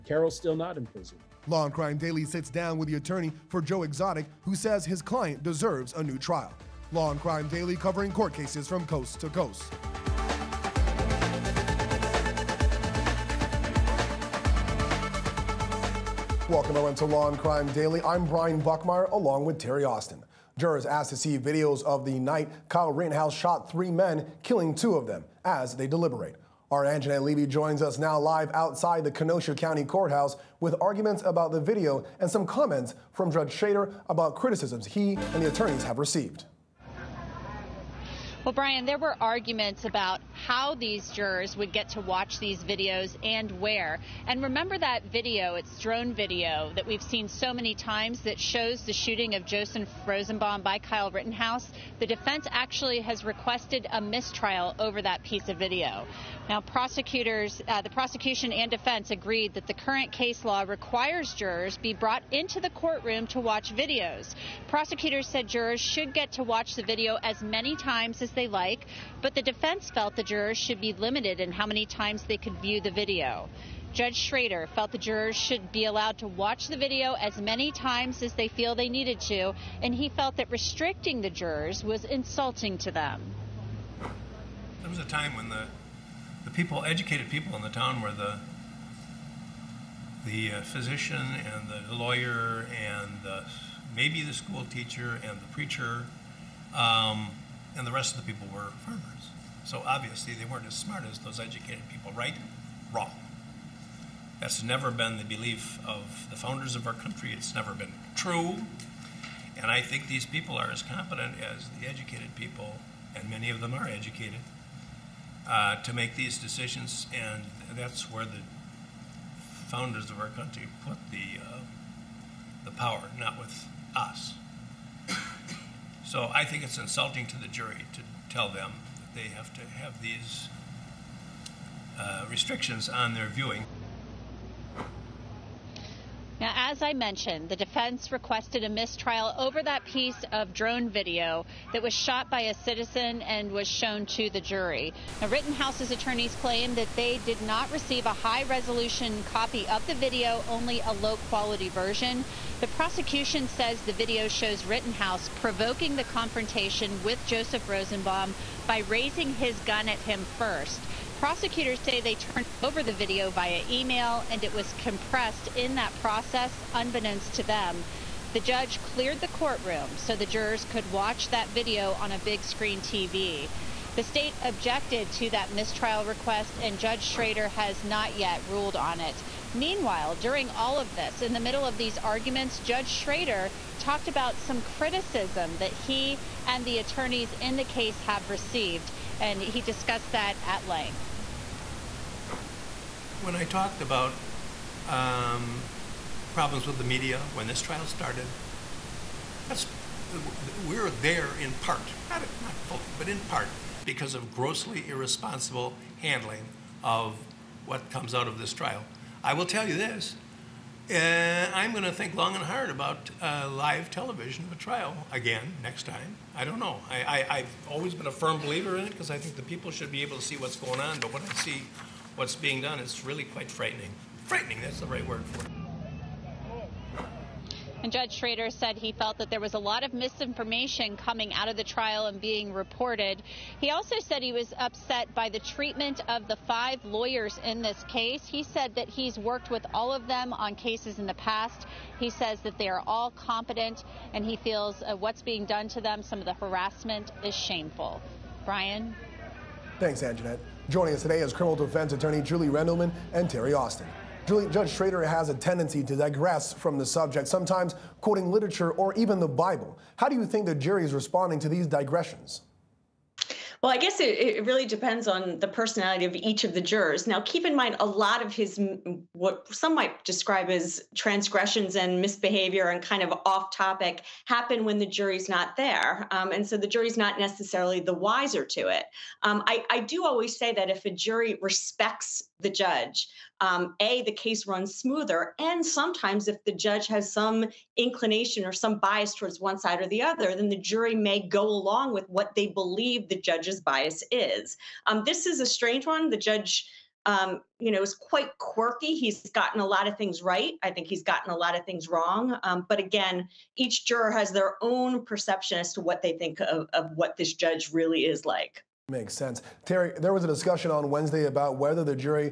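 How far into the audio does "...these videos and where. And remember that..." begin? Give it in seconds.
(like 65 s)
42 s.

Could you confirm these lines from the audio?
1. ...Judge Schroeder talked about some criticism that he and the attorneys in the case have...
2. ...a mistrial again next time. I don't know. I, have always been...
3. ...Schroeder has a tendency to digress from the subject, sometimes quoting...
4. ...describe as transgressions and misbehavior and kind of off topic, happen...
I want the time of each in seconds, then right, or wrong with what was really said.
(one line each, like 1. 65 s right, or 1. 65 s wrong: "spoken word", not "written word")
1. 182 s right
2. 214 s wrong: "trial", not "mistrial"
3. 254 s right
4. 270 s right.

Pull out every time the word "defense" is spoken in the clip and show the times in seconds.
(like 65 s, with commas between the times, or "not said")
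52 s, 58 s, 69 s, 137 s, 251 s.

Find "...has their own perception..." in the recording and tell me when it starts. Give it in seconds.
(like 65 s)
304 s.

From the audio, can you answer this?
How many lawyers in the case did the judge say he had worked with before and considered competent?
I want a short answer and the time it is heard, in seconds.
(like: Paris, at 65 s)
5, at 236 s.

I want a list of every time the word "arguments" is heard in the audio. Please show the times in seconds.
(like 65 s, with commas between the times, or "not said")
30 s, 39 s, 181 s.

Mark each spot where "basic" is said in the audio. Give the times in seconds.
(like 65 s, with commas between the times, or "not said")
not said.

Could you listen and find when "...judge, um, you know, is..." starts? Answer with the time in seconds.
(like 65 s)
296 s.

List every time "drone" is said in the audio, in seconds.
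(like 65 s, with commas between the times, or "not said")
45 s, 140 s.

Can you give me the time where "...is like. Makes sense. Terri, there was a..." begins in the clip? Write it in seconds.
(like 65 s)
308 s.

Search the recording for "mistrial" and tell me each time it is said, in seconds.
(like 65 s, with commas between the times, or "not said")
54 s, 138 s, 175 s.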